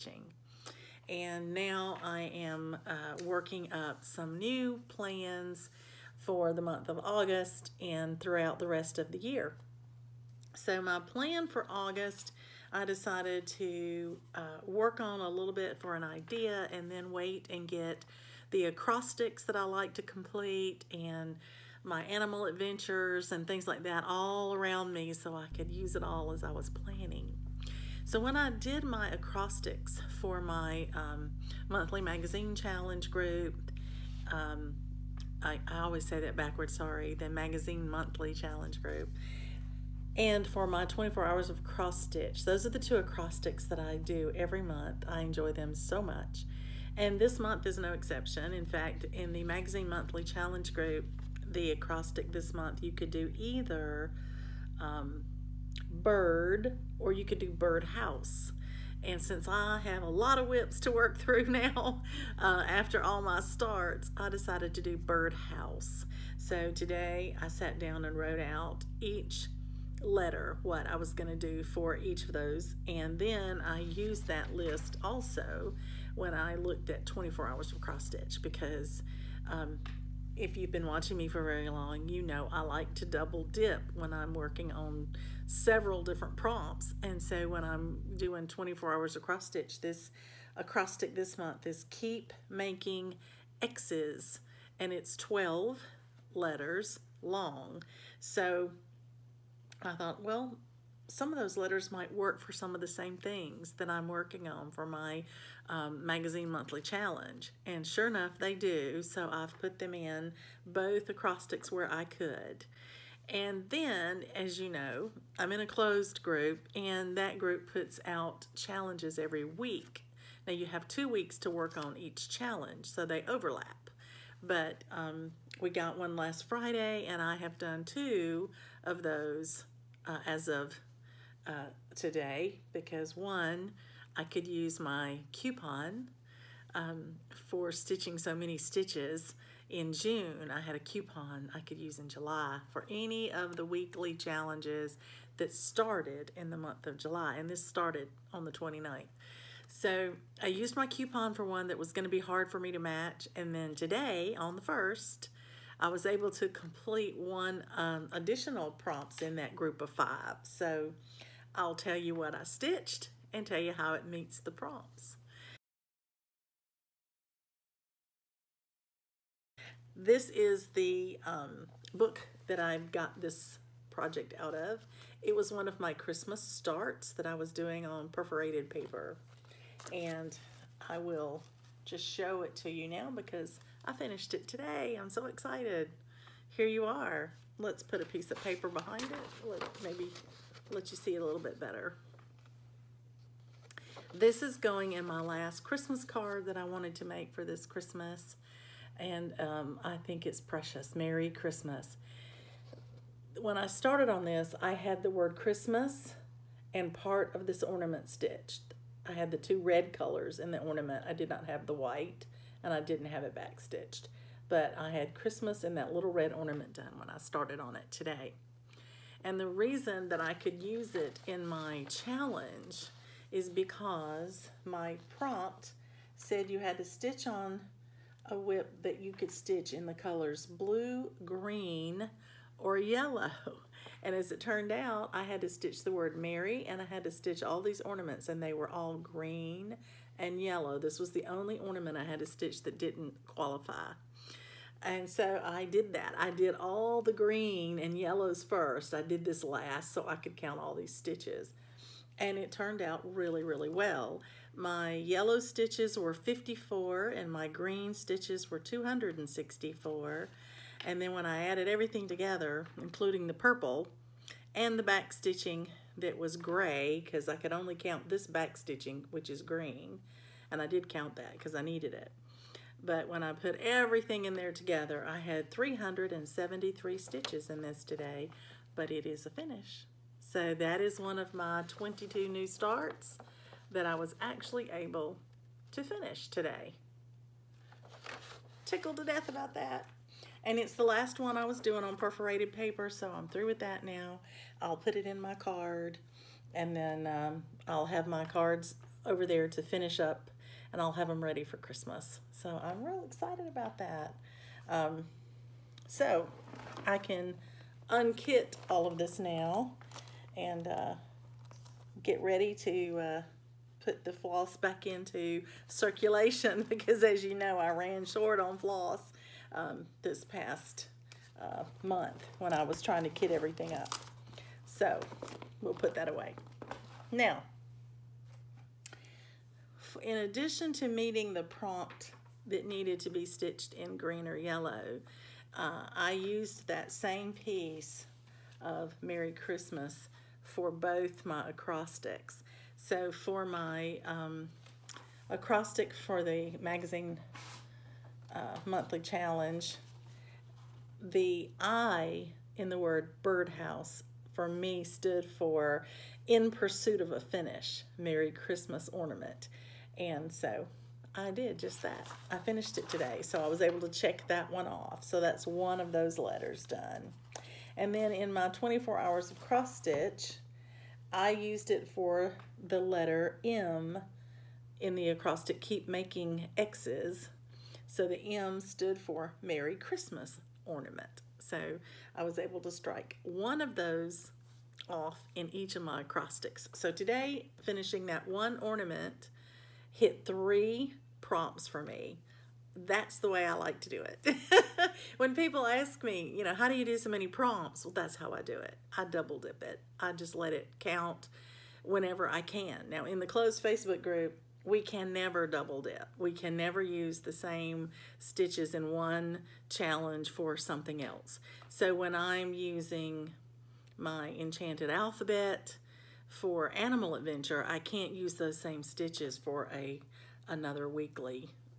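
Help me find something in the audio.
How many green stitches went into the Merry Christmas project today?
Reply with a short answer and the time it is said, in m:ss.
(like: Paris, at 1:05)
264, at 4:18.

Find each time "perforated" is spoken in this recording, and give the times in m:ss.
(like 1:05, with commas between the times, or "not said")
2:58, 4:51.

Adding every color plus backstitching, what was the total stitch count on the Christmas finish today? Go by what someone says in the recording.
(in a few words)
373.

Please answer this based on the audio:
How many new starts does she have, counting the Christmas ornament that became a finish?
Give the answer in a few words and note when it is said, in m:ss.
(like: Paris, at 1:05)
22, at 4:41.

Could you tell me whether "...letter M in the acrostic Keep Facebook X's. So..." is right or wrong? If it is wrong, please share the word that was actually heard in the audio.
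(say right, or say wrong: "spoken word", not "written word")
wrong: "Making", not "Facebook".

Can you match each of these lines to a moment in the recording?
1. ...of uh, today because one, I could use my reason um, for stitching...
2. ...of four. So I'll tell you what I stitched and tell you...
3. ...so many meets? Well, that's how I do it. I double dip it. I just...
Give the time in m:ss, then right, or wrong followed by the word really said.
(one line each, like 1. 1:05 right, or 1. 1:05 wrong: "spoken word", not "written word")
1. 2:10 wrong: "coupon", not "reason"
2. 2:39 wrong: "five", not "four"
3. 6:36 wrong: "prompts", not "meets".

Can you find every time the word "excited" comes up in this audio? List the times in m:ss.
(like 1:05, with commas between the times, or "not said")
3:05, 5:03.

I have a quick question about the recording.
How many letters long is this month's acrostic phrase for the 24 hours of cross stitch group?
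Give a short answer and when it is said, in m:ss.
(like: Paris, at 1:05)
12, at 1:35.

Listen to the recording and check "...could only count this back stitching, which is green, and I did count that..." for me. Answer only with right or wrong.
right.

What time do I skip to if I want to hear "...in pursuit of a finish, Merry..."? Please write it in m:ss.
5:56.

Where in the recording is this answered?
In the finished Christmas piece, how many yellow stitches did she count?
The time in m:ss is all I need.
4:16.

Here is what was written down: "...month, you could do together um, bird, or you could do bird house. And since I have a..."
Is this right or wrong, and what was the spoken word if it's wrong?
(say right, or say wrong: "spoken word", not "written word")
wrong: "either", not "together".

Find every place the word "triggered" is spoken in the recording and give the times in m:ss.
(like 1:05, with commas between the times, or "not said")
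not said.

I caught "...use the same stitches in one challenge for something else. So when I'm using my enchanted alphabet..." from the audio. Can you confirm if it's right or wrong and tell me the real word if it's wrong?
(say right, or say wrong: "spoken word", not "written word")
right.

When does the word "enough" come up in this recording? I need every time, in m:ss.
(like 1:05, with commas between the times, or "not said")
1:48.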